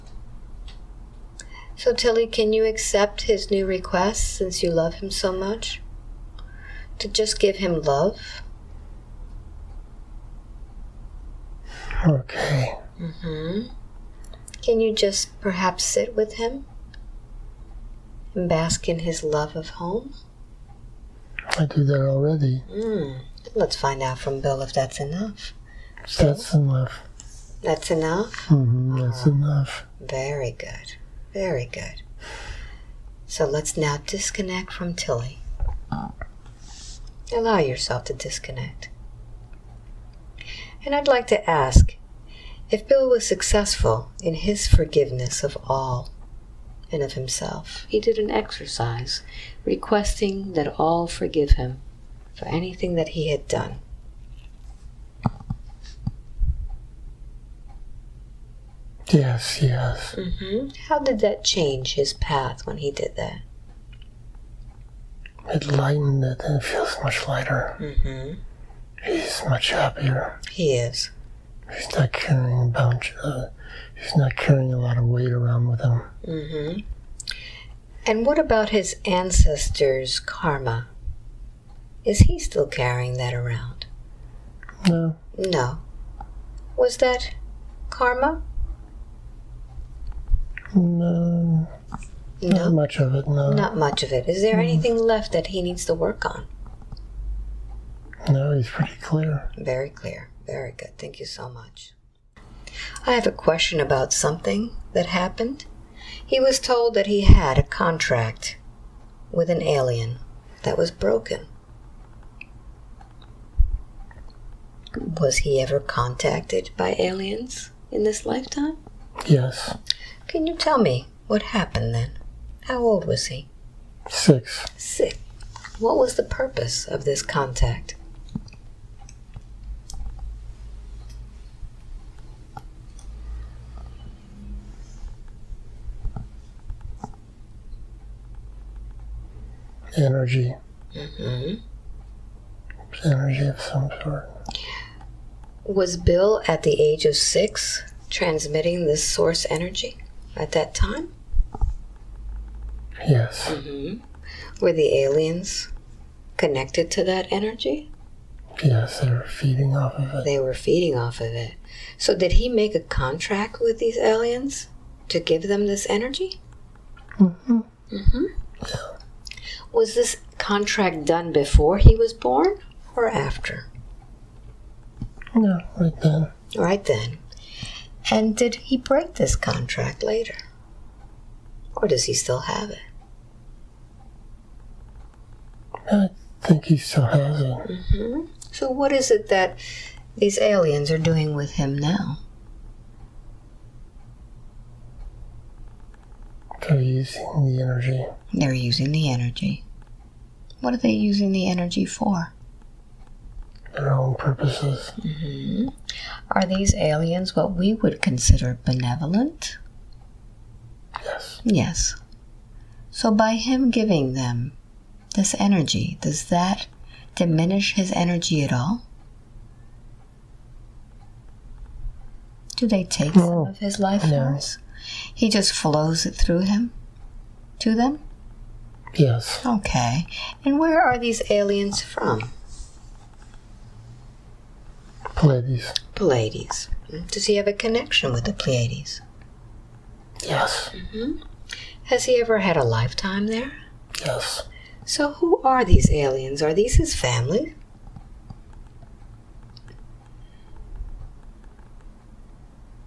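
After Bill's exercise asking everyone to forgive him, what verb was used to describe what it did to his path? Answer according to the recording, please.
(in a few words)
lightened.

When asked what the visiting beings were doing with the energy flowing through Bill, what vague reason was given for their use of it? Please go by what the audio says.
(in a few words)
Their own purposes.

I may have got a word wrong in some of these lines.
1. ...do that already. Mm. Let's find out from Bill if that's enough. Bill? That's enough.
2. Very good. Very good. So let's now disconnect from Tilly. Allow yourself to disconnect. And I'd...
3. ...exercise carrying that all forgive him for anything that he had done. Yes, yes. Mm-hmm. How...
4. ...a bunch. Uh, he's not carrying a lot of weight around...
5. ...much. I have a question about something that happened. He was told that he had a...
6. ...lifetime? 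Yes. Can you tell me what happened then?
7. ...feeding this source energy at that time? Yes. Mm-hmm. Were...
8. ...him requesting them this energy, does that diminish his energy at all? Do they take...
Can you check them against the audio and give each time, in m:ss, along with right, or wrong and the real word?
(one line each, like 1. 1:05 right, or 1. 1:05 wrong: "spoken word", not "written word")
1. 0:21 right
2. 0:30 right
3. 0:48 wrong: "requesting", not "carrying"
4. 1:12 right
5. 1:41 right
6. 1:58 right
7. 2:28 wrong: "transmitting", not "feeding"
8. 3:33 wrong: "giving", not "requesting".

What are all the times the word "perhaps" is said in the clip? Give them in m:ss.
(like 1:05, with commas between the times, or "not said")
0:15.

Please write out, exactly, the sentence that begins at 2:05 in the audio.
What was the purpose of this contact?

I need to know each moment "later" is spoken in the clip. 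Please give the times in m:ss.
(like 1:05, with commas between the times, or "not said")
3:00.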